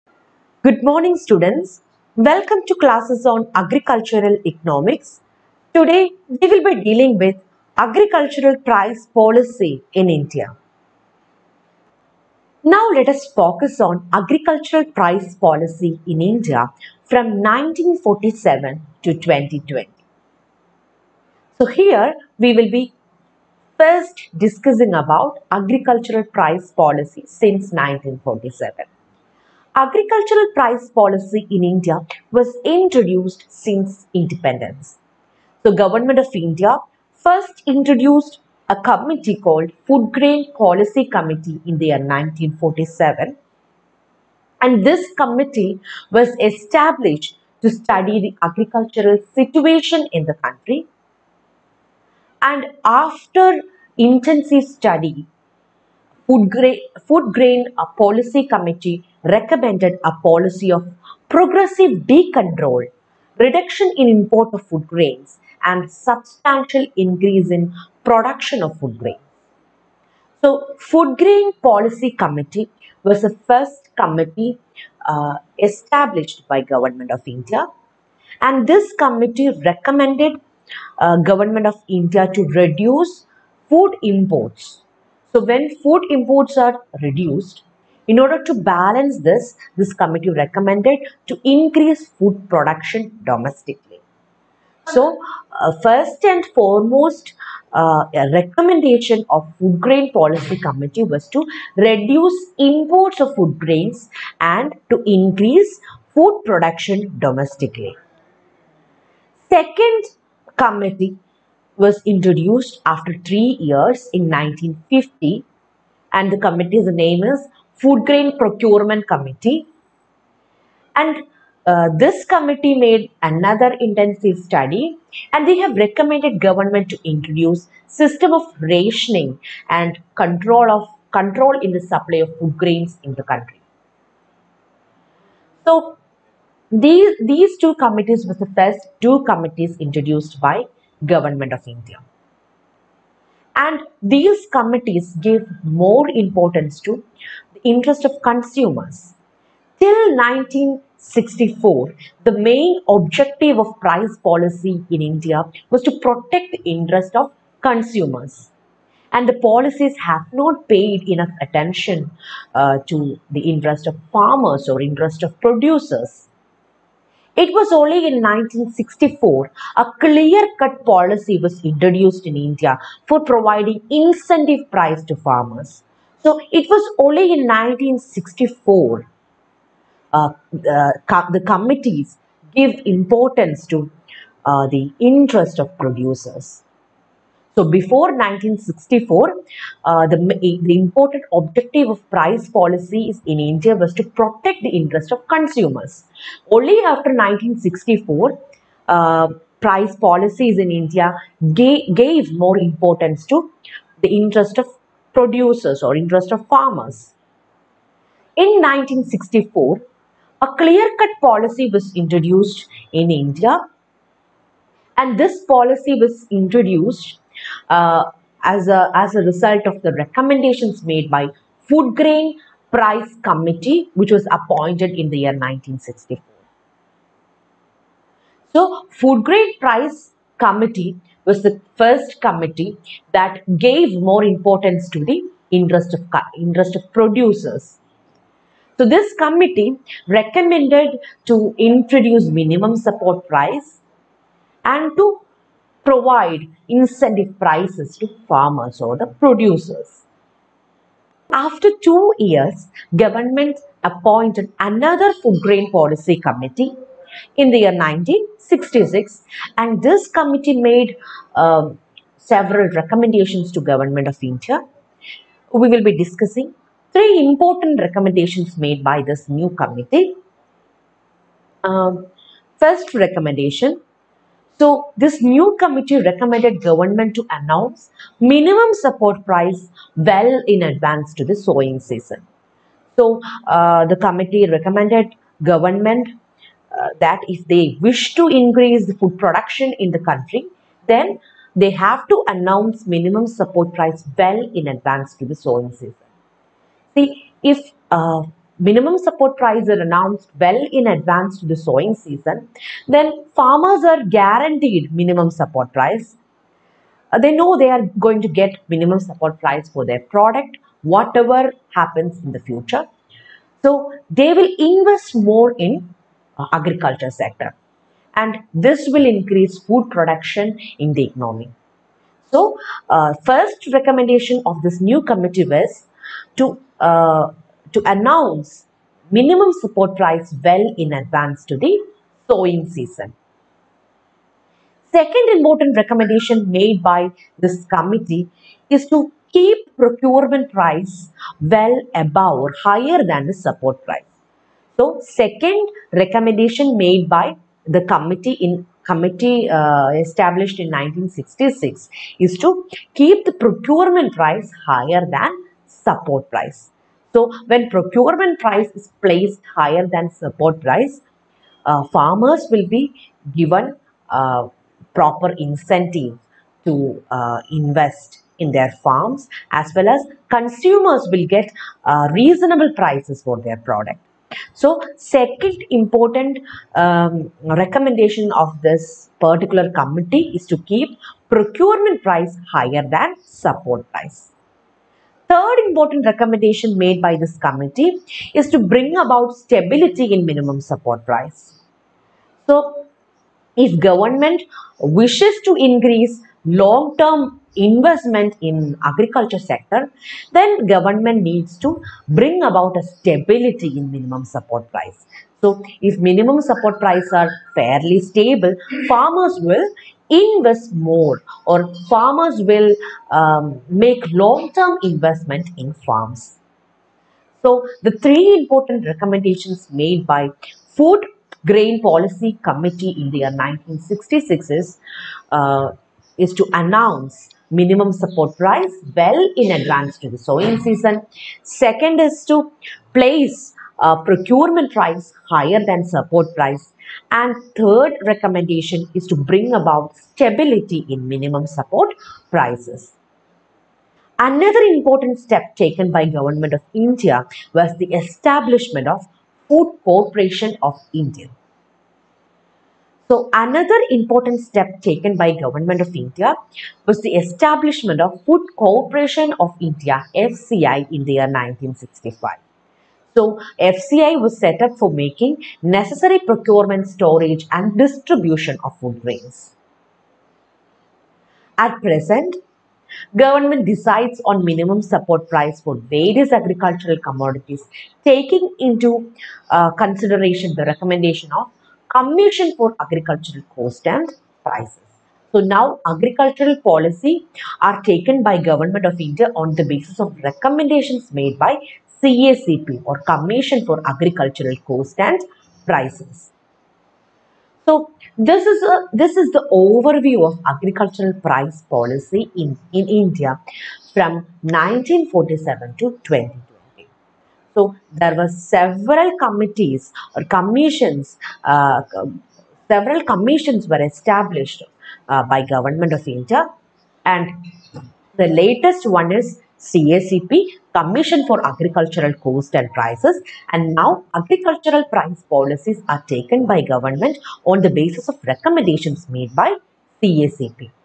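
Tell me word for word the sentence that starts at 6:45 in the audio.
So if minimum support price are fairly stable, farmers will invest more or farmers will um, make long-term investment in farms.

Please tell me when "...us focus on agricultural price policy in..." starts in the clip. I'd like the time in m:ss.
0:13.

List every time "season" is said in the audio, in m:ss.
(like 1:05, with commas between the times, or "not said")
4:41, 4:55, 5:01, 5:32, 7:10.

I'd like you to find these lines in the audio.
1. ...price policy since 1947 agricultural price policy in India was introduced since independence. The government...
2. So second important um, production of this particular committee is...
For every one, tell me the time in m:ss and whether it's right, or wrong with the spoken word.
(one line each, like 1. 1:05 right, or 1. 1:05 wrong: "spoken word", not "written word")
1. 0:26 right
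2. 6:14 wrong: "recommendation", not "production".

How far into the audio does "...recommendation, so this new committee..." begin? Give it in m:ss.
4:32.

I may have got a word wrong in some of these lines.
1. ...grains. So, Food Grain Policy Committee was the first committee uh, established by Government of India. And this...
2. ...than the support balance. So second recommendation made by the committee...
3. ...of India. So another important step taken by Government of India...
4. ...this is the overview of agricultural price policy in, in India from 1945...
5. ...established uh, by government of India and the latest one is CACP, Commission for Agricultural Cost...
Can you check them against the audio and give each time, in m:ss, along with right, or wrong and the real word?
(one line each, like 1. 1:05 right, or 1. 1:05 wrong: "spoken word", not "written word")
1. 1:08 right
2. 5:43 wrong: "price", not "balance"
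3. 7:30 right
4. 8:18 wrong: "1947", not "1945"
5. 8:33 right.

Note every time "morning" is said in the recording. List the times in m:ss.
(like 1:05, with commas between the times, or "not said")
0:00.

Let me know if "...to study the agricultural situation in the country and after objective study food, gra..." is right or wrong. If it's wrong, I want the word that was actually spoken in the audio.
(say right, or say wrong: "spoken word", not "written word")
wrong: "intensive", not "objective".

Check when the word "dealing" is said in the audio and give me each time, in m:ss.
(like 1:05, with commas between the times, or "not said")
0:06.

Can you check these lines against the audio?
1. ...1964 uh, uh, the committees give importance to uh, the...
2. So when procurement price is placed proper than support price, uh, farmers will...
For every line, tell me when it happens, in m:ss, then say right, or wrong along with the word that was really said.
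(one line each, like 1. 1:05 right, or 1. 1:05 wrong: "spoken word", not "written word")
1. 2:57 right
2. 5:57 wrong: "higher", not "proper".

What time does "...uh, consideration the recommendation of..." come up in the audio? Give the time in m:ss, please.
7:59.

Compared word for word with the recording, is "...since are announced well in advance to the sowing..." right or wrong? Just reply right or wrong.
wrong.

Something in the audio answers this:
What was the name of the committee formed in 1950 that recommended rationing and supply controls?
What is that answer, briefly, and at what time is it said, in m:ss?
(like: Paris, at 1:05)
Food Grain Procurement Committee, at 1:57.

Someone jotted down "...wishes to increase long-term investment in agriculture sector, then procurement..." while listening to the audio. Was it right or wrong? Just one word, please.
wrong.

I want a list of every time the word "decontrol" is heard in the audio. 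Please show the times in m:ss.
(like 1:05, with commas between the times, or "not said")
1:02.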